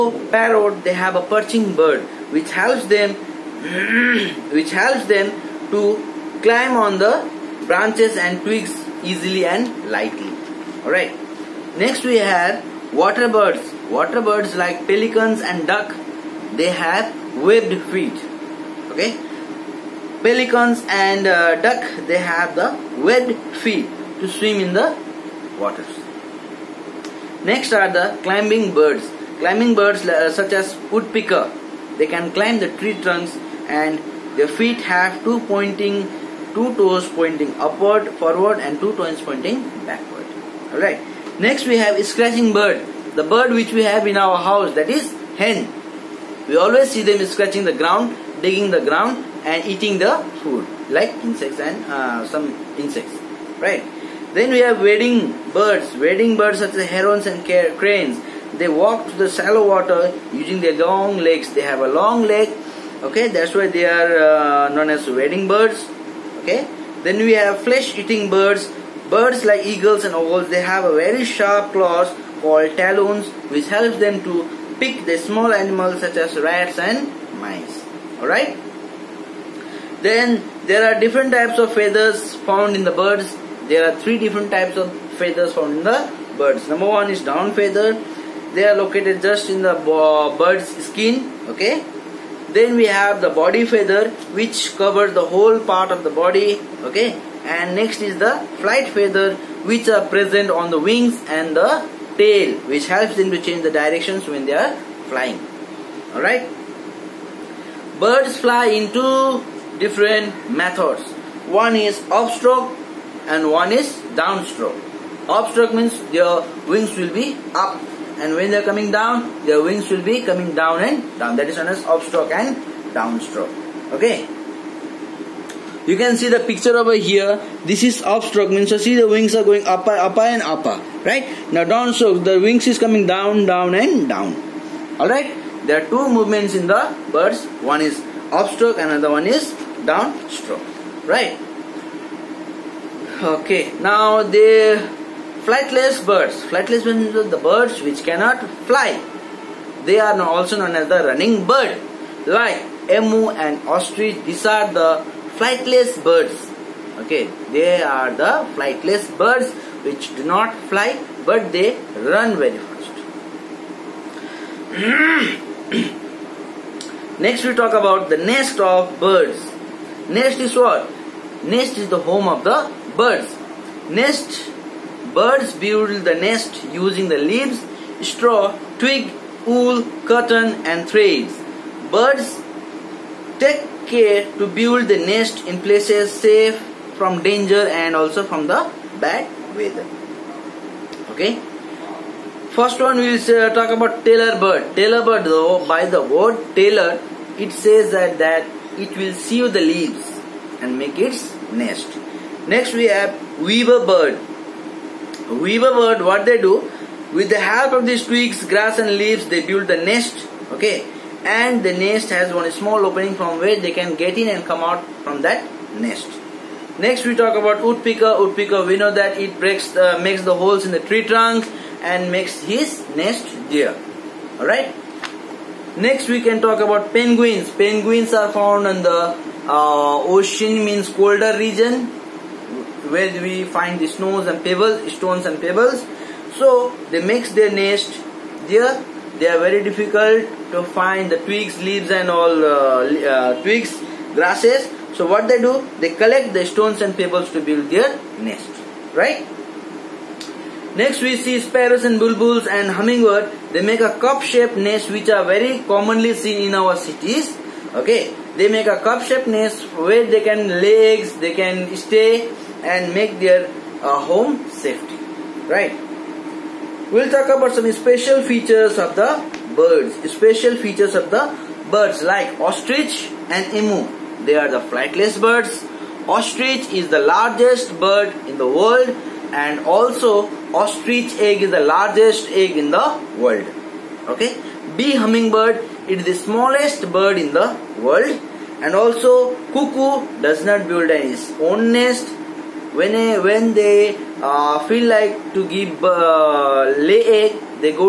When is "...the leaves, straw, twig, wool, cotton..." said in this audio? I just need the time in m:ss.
2:57.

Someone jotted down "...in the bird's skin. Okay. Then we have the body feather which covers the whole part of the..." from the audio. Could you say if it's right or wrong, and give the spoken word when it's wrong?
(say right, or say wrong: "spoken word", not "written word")
right.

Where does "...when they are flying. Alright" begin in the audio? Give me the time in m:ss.
1:44.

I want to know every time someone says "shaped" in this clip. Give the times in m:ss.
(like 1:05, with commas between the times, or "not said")
4:13, 4:18.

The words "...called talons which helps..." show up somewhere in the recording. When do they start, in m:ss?
1:12.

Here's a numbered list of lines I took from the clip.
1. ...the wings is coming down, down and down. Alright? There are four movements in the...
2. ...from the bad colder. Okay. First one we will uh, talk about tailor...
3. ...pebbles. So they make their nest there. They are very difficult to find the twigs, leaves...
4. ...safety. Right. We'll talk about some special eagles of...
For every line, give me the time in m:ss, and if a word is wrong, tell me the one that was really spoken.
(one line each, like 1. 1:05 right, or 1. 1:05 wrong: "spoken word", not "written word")
1. 2:12 wrong: "two", not "four"
2. 3:08 wrong: "weather", not "colder"
3. 3:55 right
4. 4:24 wrong: "features", not "eagles".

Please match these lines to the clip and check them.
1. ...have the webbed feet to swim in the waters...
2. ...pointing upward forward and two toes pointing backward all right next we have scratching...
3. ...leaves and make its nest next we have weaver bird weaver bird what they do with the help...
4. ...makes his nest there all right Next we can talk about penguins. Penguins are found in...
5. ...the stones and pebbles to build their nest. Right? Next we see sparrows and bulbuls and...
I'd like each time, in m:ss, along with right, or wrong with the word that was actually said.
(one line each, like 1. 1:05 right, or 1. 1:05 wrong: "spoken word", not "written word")
1. 0:22 right
2. 0:37 right
3. 3:19 right
4. 3:42 right
5. 4:06 right.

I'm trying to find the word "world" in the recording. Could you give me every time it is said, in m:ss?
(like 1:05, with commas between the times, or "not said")
4:38, 4:43, 4:47.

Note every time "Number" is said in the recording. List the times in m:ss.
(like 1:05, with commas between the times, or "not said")
1:26.